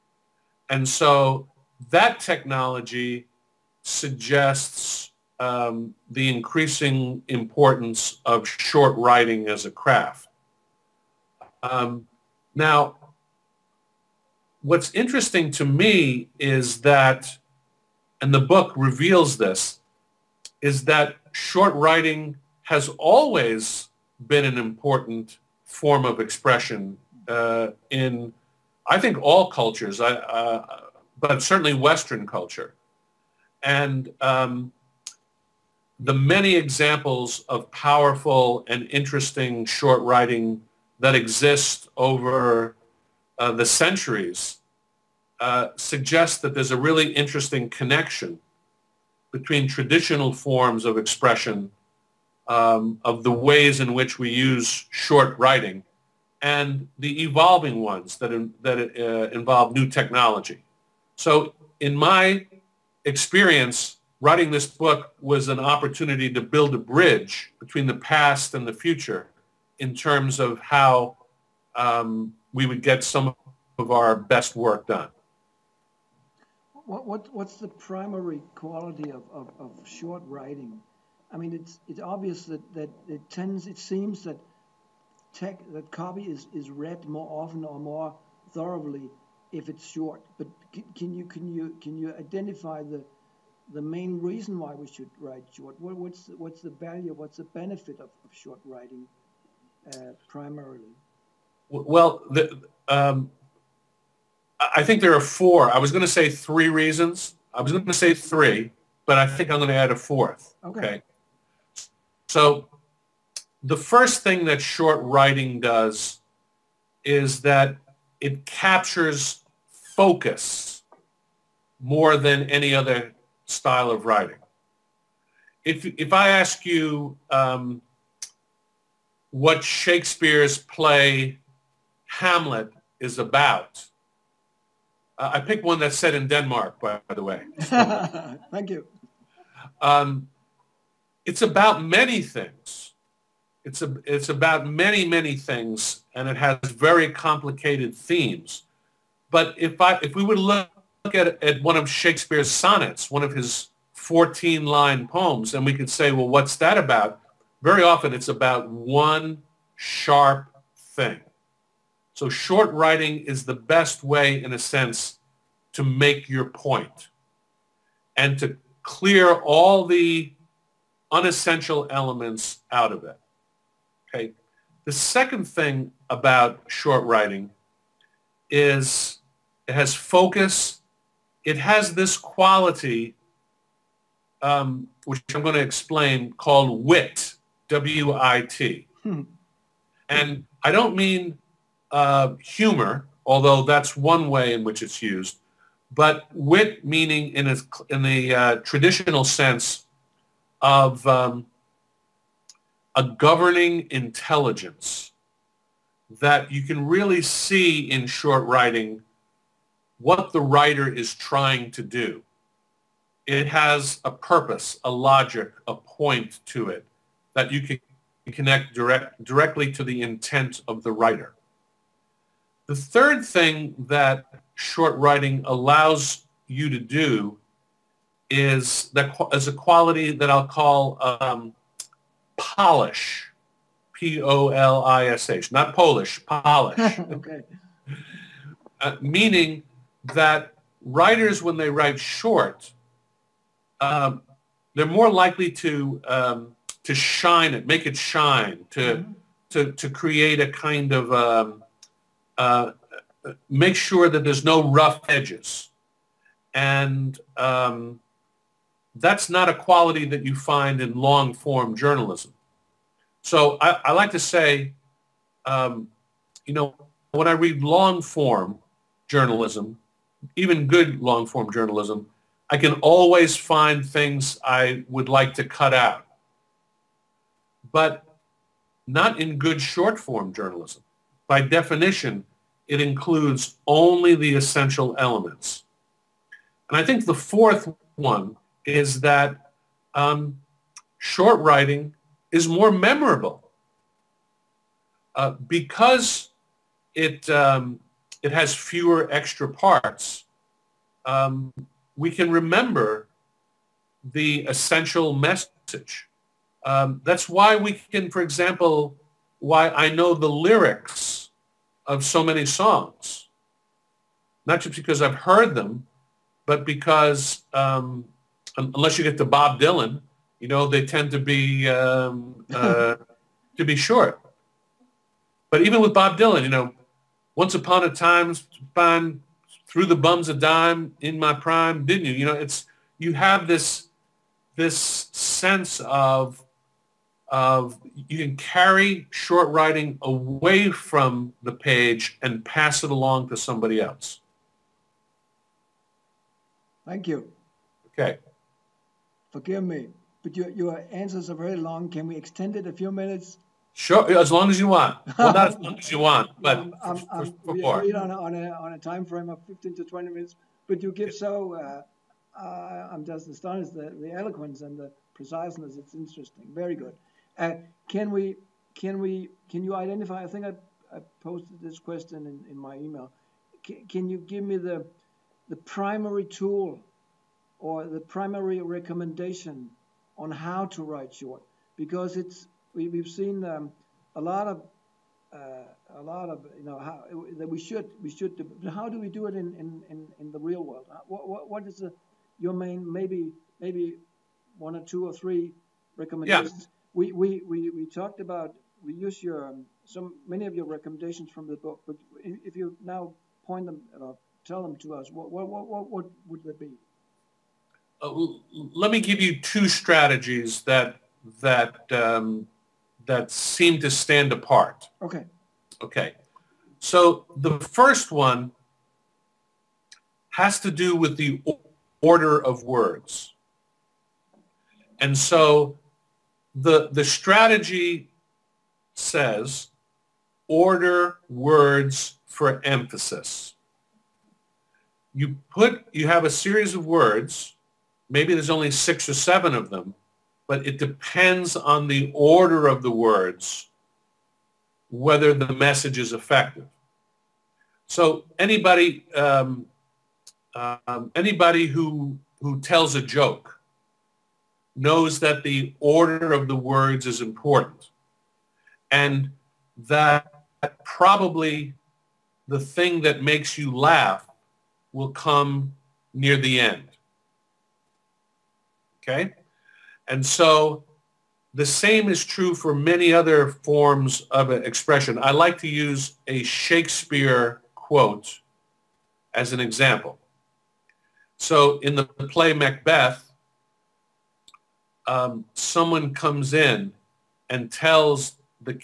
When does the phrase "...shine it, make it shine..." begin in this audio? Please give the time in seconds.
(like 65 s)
246 s.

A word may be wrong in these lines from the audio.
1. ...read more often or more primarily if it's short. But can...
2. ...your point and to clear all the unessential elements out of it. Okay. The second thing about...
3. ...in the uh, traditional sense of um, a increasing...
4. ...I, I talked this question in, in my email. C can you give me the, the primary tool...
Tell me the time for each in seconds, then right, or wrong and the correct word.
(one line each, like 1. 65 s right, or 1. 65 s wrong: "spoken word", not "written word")
1. 86 s wrong: "thoroughly", not "primarily"
2. 166 s right
3. 197 s wrong: "governing", not "increasing"
4. 370 s wrong: "posted", not "talked".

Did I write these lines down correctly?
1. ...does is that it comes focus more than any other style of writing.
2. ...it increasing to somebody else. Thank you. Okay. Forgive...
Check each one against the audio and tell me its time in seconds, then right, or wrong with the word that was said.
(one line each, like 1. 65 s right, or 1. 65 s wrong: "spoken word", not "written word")
1. 115 s wrong: "captures", not "comes"
2. 342 s wrong: "along", not "increasing".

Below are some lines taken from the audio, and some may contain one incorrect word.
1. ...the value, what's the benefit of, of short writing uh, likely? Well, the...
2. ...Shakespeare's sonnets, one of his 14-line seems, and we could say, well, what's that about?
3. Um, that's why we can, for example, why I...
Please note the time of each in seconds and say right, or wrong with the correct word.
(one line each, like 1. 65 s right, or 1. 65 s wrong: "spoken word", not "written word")
1. 96 s wrong: "primarily", not "likely"
2. 151 s wrong: "poems", not "seems"
3. 306 s right.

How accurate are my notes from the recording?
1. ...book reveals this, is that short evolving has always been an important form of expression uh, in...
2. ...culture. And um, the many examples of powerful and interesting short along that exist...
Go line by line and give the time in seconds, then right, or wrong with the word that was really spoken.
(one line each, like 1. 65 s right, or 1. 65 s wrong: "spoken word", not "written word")
1. 18 s wrong: "writing", not "evolving"
2. 32 s wrong: "writing", not "along".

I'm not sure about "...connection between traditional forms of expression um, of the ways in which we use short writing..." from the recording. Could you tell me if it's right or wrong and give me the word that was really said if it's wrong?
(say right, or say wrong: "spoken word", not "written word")
right.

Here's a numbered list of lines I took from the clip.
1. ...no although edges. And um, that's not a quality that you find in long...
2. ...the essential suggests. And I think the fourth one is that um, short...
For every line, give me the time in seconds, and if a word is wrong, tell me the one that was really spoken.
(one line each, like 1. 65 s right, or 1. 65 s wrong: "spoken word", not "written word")
1. 254 s wrong: "rough", not "although"
2. 284 s wrong: "elements", not "suggests".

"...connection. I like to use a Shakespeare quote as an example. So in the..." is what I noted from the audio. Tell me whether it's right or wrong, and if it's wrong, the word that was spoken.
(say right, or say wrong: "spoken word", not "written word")
wrong: "expression", not "connection".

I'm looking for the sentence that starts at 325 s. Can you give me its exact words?
But even with Bob Dylan, you know, once upon a time, fine, through the bums a dime in my prime, didn't you?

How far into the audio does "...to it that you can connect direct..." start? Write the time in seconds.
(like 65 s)
216 s.